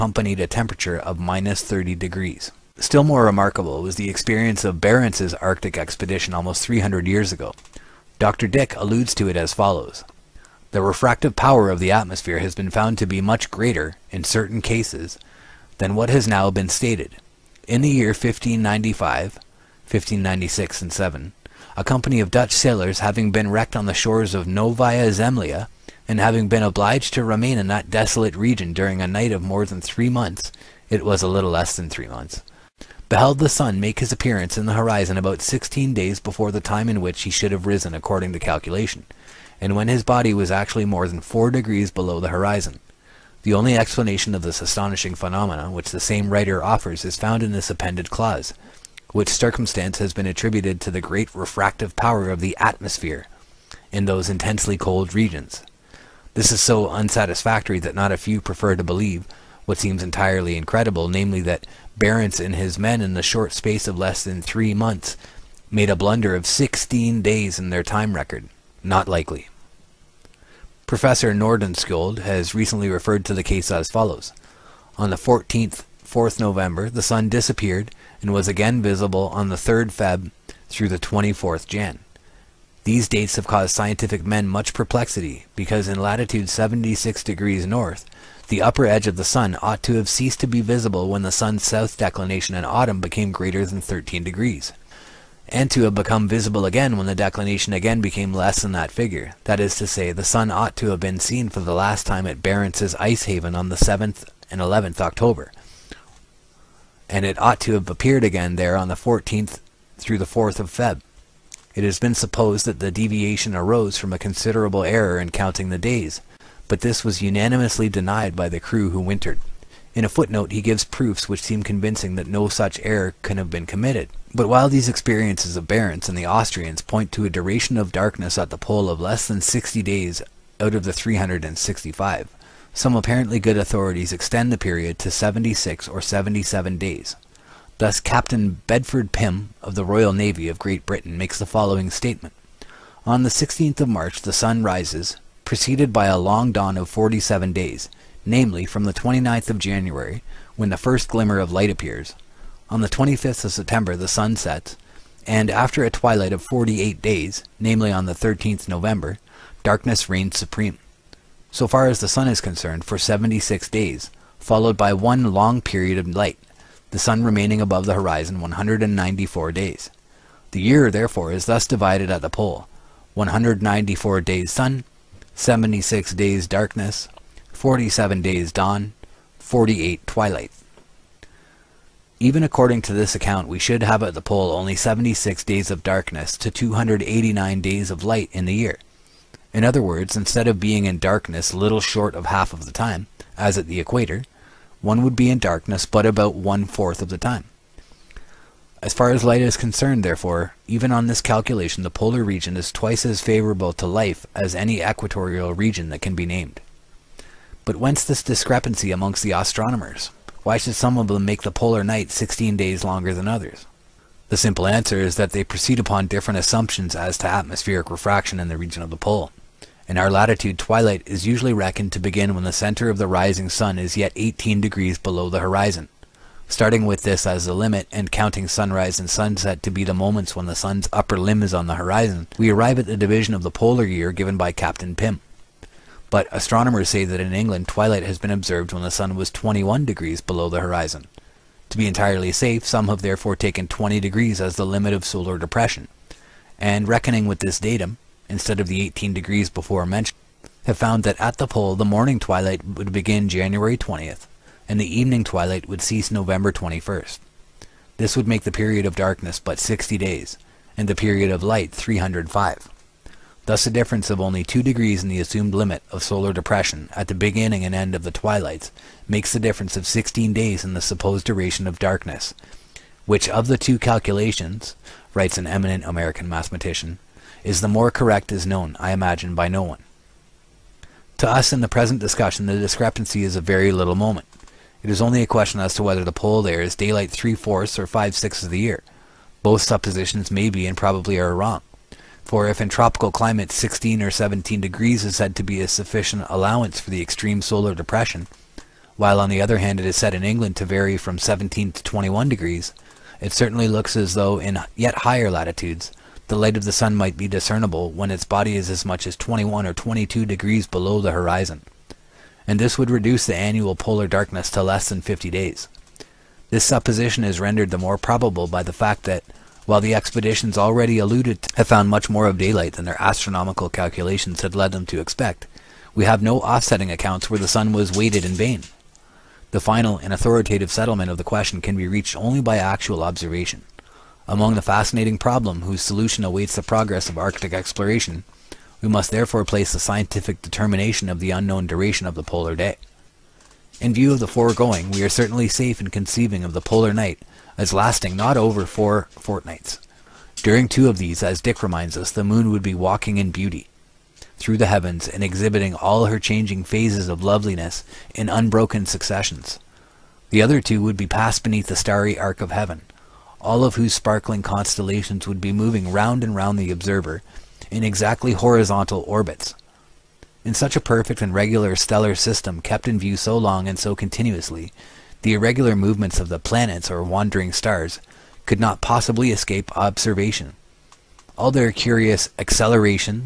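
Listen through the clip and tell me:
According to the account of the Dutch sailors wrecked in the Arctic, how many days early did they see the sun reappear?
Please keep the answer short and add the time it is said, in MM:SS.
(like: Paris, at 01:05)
16 days, at 00:35.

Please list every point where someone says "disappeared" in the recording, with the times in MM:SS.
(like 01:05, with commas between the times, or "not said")
01:17.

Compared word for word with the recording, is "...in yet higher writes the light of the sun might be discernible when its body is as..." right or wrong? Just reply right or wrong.
wrong.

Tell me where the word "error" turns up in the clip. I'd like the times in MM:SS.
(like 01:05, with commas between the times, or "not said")
01:54, 02:02.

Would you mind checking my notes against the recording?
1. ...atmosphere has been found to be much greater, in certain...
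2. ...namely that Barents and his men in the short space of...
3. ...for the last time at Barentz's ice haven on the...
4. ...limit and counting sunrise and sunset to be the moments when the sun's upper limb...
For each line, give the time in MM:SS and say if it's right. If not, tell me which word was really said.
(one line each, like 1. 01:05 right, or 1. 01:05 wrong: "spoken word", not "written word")
1. 00:11 right
2. 01:01 right
3. 01:41 right
4. 03:47 right.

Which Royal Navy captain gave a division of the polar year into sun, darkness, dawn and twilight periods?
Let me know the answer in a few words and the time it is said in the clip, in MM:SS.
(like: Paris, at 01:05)
Bedford Pim, at 02:18.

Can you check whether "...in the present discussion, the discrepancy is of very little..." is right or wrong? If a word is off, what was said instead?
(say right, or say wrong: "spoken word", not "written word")
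right.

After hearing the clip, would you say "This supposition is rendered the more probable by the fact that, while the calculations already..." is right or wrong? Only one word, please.
wrong.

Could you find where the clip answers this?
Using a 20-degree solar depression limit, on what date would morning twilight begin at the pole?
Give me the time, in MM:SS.
04:13.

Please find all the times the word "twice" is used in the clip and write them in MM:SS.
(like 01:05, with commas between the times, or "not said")
03:22.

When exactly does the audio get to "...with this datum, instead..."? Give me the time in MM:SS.
04:07.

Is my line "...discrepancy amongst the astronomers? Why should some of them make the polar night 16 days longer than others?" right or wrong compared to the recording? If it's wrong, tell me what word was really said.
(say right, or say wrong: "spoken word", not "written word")
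right.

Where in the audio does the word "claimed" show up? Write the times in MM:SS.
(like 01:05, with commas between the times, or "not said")
not said.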